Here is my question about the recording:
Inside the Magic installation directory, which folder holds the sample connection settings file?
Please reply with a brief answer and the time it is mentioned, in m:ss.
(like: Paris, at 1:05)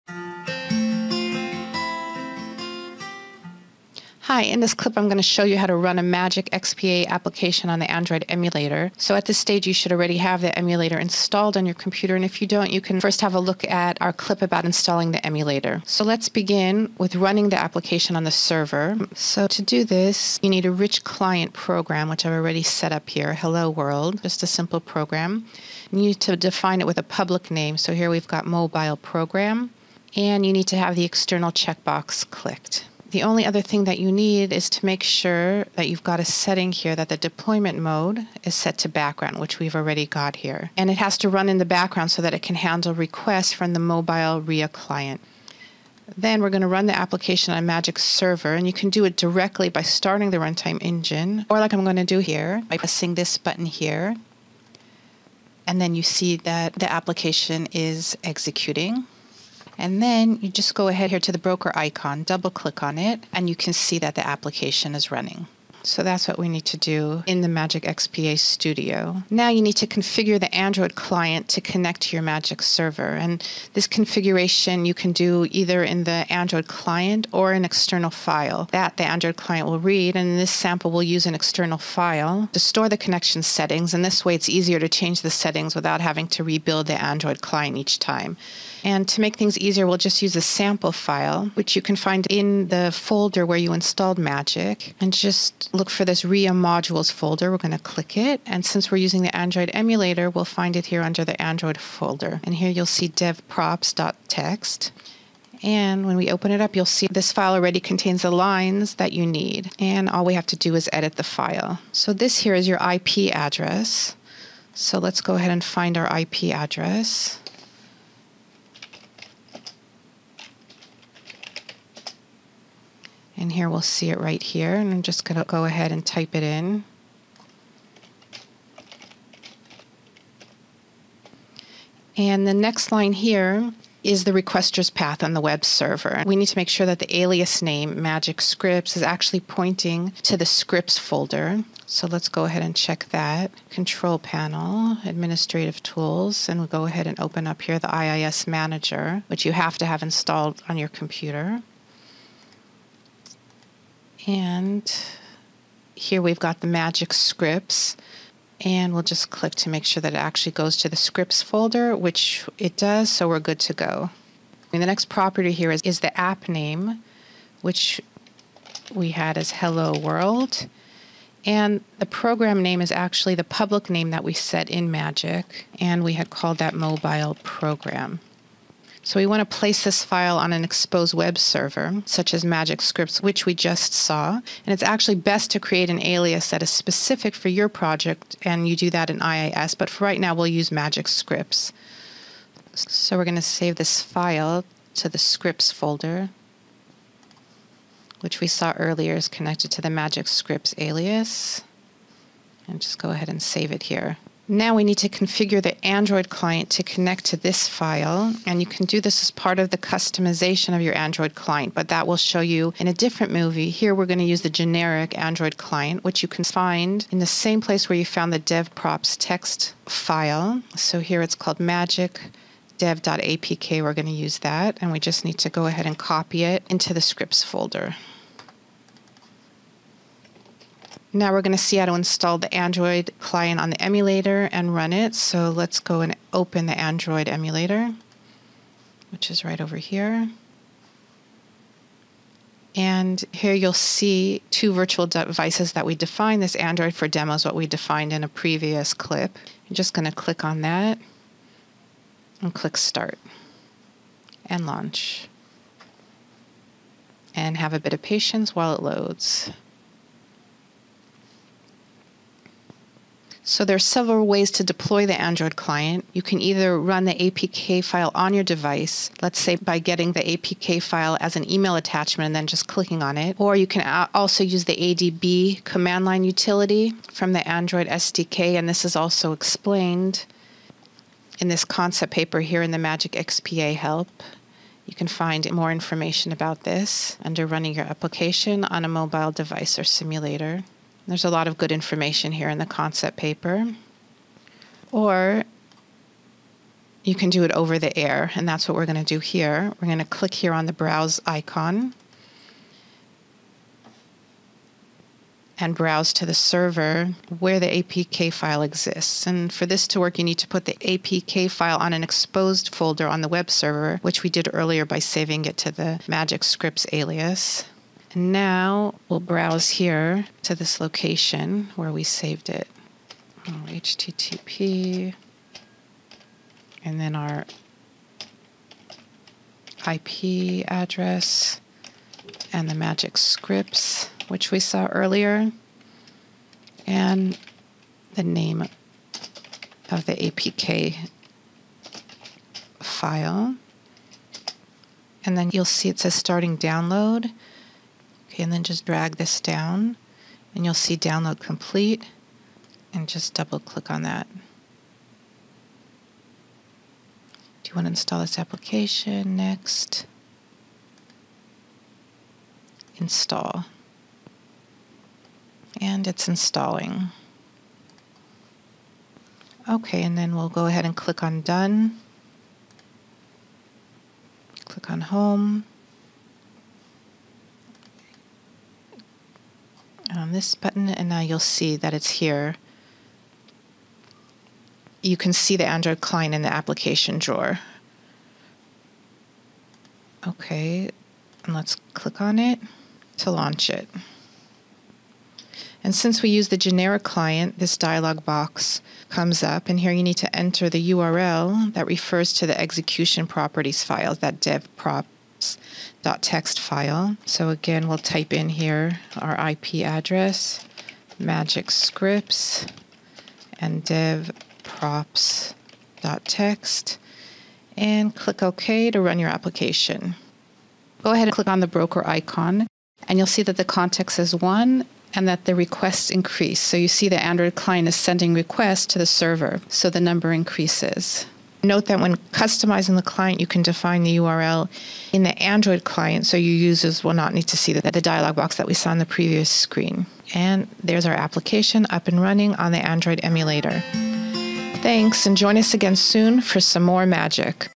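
RIA modules, at 1:36.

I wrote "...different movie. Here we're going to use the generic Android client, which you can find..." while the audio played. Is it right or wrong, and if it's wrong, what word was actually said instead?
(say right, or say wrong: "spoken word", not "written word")
right.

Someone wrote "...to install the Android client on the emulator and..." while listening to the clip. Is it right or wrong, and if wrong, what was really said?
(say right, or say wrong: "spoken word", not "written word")
right.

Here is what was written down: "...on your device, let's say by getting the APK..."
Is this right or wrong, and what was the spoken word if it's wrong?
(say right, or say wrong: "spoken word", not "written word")
right.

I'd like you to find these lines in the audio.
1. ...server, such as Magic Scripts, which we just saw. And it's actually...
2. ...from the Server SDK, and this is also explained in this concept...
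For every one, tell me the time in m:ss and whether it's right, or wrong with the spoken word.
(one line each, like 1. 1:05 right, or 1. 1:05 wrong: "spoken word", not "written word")
1. 3:01 right
2. 4:37 wrong: "Android", not "Server".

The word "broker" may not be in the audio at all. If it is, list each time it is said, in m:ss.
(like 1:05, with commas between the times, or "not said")
1:01, 7:01.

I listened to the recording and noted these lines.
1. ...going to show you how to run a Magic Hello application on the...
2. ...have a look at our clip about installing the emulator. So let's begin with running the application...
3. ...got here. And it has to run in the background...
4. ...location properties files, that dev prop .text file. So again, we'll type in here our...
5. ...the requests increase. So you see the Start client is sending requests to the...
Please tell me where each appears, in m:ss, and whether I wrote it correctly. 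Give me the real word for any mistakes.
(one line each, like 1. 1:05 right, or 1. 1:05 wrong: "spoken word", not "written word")
1. 0:05 wrong: "XPA", not "Hello"
2. 0:13 right
3. 0:40 right
4. 6:42 wrong: "execution", not "location"
5. 7:05 wrong: "Android", not "Start".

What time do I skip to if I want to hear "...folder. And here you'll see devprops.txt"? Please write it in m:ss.
1:41.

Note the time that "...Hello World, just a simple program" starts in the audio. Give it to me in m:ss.
0:23.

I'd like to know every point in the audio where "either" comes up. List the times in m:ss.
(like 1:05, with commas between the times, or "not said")
1:15, 4:26.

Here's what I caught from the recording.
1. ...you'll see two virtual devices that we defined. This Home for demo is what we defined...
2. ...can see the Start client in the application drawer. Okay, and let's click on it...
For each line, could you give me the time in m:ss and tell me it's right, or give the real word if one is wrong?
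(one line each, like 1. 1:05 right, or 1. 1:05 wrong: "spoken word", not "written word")
1. 4:03 wrong: "Android", not "Home"
2. 6:25 wrong: "Android", not "Start".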